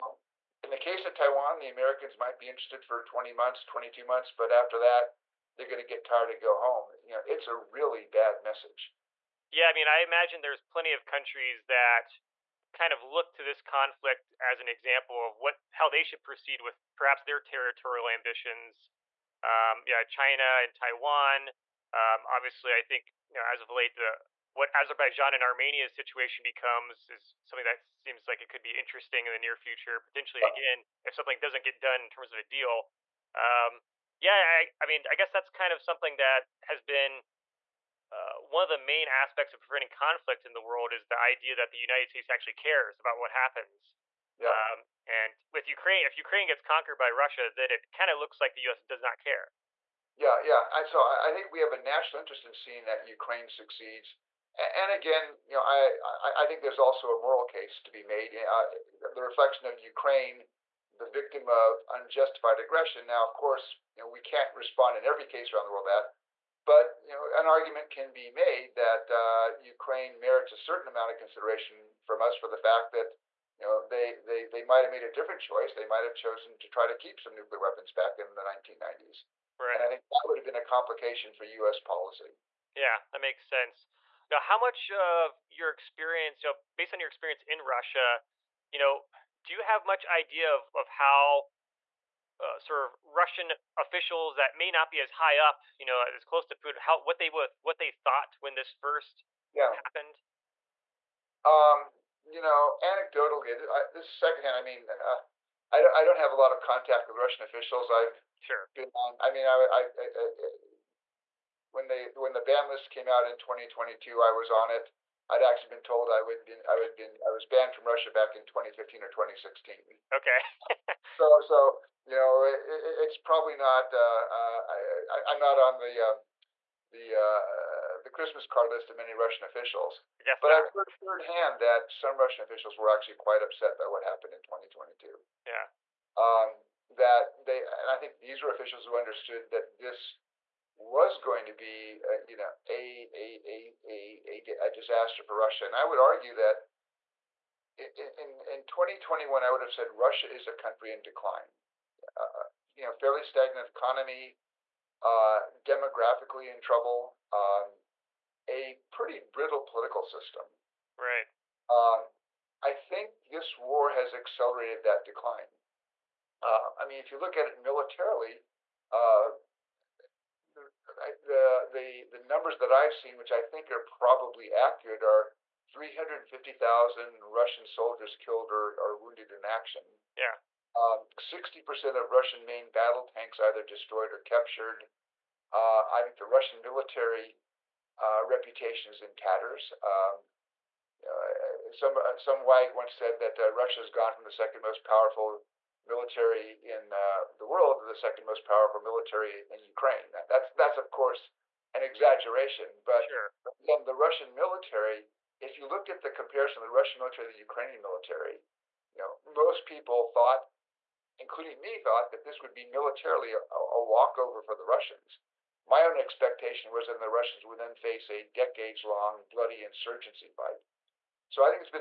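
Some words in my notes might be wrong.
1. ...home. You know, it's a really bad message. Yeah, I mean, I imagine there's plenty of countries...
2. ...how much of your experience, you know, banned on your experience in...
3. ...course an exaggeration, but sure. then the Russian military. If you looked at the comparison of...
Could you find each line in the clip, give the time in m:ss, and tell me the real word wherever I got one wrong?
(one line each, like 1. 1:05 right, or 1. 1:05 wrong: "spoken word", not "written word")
1. 0:06 right
2. 1:24 wrong: "based", not "banned"
3. 3:20 right.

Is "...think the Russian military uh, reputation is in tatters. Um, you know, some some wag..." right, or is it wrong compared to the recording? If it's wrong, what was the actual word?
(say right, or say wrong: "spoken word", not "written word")
right.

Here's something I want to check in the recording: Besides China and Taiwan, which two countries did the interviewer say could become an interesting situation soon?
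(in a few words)
Azerbaijan and Armenia.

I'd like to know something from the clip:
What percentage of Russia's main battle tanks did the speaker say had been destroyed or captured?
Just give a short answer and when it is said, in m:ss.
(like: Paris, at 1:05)
60%, at 3:01.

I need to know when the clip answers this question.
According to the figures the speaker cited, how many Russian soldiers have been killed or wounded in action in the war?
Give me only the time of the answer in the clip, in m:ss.
2:55.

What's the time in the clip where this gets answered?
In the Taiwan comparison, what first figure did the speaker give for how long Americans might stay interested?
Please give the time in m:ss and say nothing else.
0:03.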